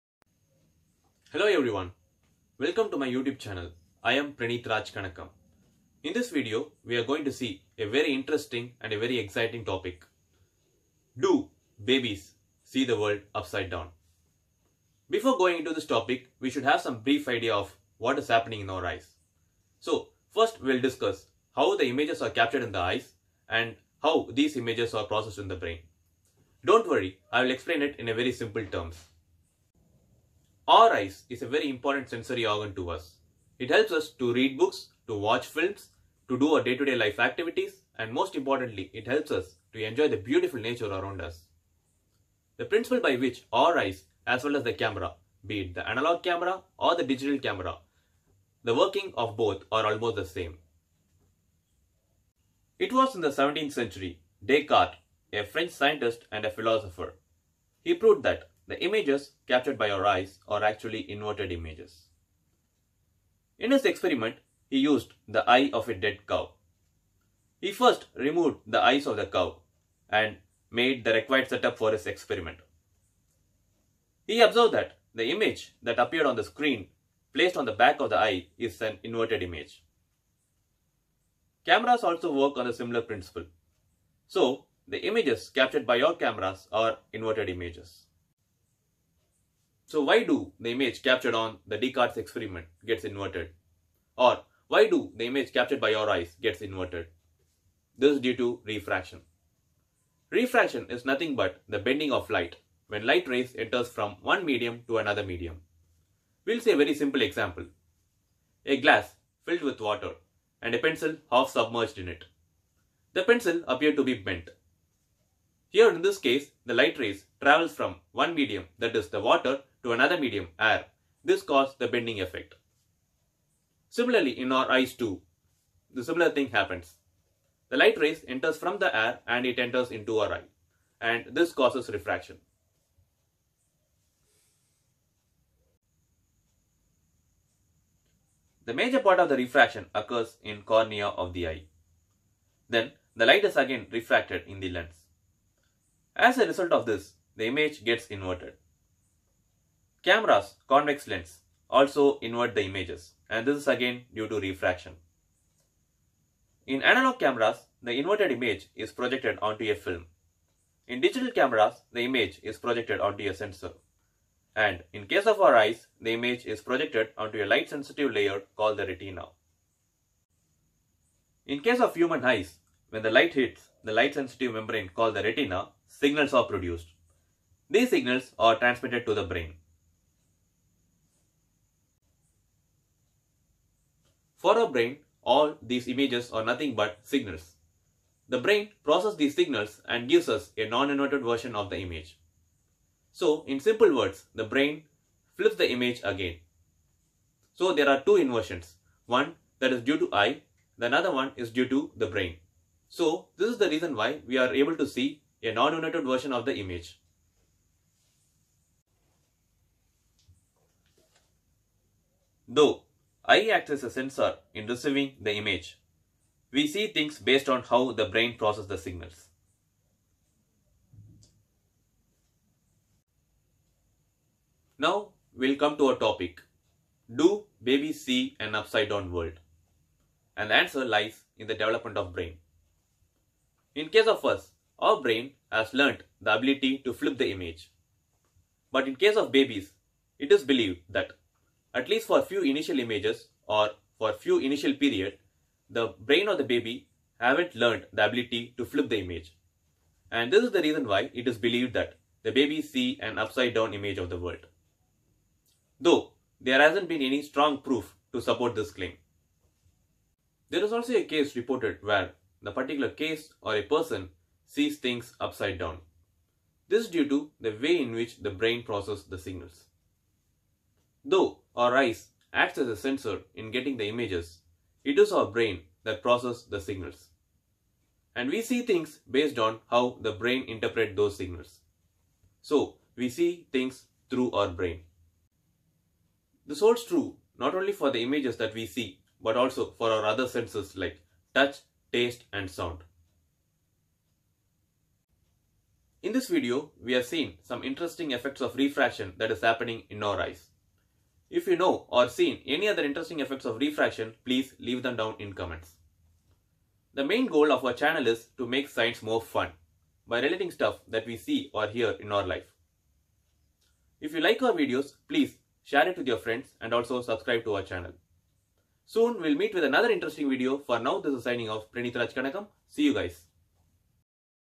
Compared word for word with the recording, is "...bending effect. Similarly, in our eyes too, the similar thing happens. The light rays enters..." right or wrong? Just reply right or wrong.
right.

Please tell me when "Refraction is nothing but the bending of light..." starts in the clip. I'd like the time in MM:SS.
01:40.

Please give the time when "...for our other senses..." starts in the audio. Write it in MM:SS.
04:49.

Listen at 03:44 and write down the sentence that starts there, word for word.
Now we'll come to our topic.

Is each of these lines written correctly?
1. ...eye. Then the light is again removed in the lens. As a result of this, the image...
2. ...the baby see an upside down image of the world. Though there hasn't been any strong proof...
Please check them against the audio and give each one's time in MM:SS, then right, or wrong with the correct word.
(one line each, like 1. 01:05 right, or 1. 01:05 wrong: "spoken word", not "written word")
1. 02:21 wrong: "refracted", not "removed"
2. 04:12 right.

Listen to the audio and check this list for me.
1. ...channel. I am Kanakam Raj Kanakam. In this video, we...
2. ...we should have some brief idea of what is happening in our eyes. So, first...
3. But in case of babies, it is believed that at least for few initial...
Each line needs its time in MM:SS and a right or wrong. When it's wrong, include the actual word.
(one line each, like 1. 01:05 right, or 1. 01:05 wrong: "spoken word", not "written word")
1. 00:03 wrong: "Praneeth", not "Kanakam"
2. 00:16 right
3. 03:58 right.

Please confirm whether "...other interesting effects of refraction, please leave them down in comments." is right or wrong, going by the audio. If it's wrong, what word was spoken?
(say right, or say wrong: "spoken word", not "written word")
right.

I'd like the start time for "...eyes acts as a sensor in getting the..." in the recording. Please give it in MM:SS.
04:31.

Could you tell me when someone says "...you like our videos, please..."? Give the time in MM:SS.
05:14.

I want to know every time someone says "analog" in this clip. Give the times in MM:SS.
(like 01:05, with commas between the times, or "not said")
00:45, 02:36.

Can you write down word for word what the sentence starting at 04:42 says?
So, we see things through our brain.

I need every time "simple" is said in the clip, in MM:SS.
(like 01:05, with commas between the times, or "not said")
00:28, 01:46, 03:13.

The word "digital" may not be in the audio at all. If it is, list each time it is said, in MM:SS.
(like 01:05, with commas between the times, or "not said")
00:47, 02:41.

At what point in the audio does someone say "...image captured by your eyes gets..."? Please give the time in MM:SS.
01:35.